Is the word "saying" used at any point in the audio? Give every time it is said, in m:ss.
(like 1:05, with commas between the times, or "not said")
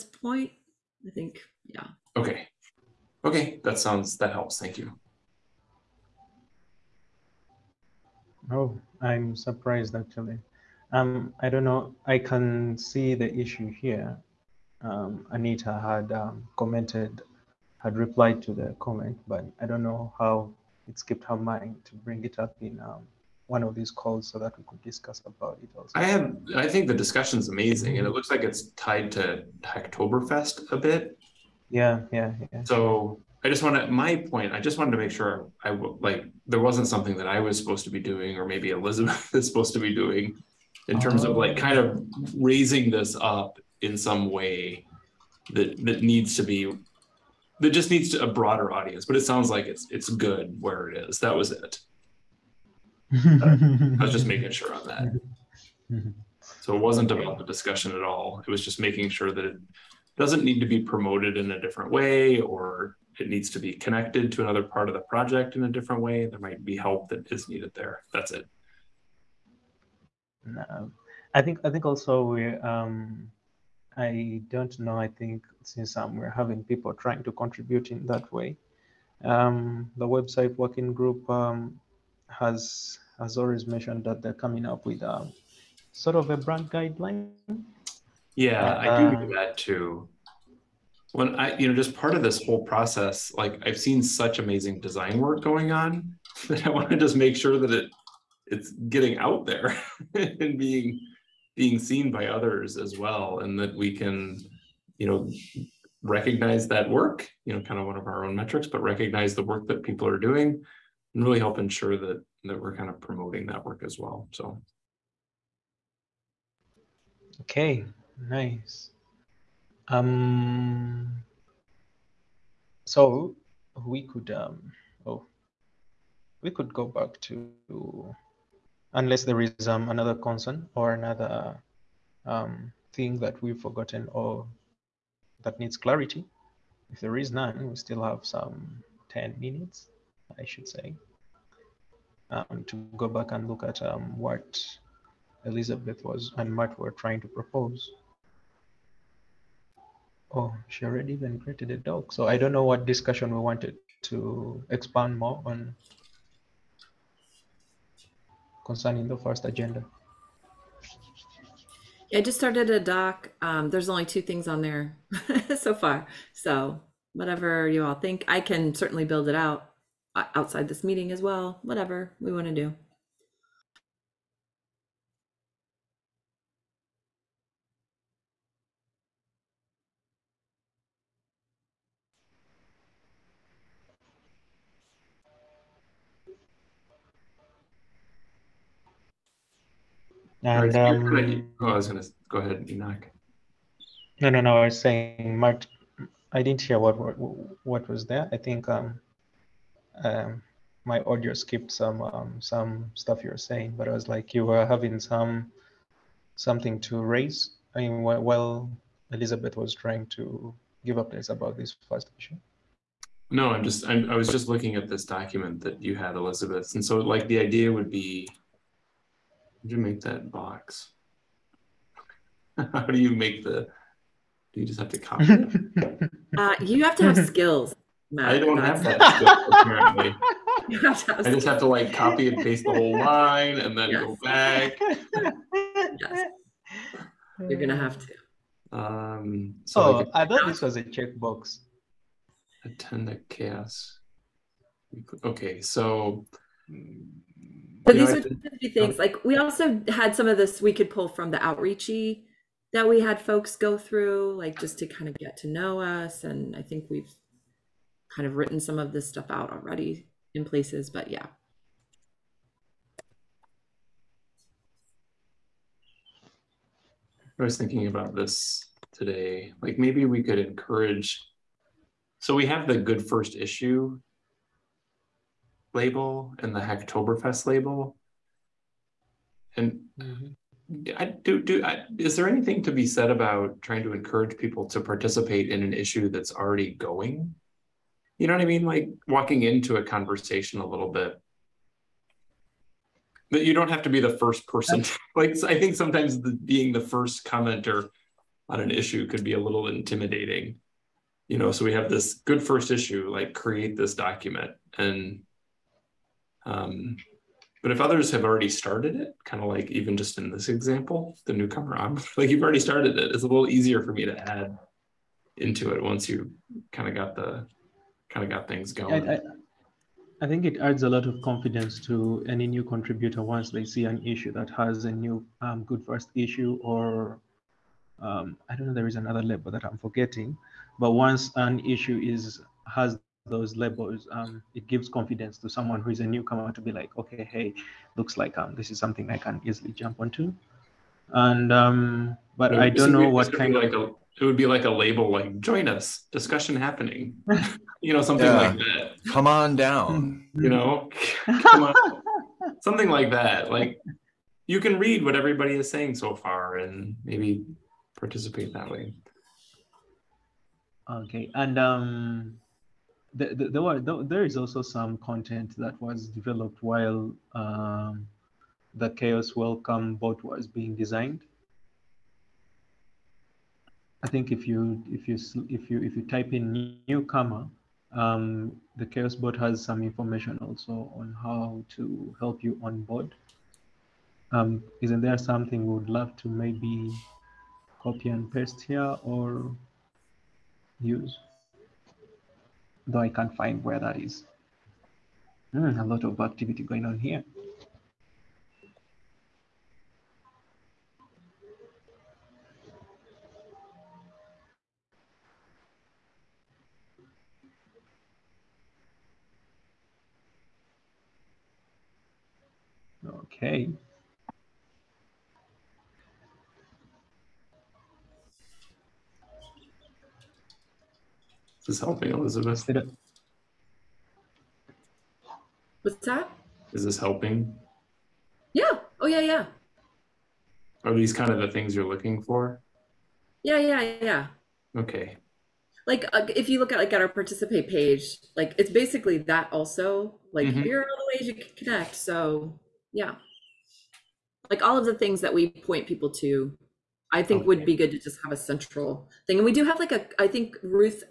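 3:14, 3:23, 5:55.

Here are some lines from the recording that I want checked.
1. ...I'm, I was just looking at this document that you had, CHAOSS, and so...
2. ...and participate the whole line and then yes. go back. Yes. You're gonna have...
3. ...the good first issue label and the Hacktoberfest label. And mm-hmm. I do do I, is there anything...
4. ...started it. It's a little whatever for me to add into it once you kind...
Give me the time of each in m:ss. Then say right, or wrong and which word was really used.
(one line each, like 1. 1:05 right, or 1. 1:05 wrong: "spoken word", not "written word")
1. 3:33 wrong: "Elizabeth", not "CHAOSS"
2. 3:52 wrong: "paste", not "participate"
3. 4:32 right
4. 5:12 wrong: "easier", not "whatever".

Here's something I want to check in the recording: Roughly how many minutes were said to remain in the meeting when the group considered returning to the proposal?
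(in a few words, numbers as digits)
10.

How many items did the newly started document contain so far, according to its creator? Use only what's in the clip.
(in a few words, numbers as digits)
2.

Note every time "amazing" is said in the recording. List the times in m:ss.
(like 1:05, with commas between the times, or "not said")
0:27, 1:34.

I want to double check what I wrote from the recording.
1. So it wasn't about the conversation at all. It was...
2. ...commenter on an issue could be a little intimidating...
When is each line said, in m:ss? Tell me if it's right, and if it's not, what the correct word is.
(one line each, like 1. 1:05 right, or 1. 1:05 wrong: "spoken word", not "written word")
1. 0:56 wrong: "discussion", not "conversation"
2. 4:57 right.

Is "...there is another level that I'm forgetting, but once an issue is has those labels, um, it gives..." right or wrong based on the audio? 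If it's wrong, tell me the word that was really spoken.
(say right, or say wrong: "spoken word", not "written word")
right.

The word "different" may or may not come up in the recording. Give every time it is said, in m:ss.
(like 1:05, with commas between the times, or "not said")
1:01, 1:05.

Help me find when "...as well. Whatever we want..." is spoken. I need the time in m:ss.
2:51.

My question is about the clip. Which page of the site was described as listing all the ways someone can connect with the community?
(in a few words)
participate page.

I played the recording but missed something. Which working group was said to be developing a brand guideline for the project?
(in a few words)
website working group.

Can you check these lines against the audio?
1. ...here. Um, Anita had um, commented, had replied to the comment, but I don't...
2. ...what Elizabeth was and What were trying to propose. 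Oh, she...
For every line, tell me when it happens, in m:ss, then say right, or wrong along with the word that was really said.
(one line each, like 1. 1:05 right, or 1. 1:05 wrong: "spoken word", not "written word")
1. 0:13 right
2. 2:24 wrong: "Matt", not "What".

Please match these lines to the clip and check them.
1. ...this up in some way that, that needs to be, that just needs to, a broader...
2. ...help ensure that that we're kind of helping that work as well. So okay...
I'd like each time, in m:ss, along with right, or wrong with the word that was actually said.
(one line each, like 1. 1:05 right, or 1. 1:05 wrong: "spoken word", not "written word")
1. 0:42 right
2. 1:51 wrong: "promoting", not "helping".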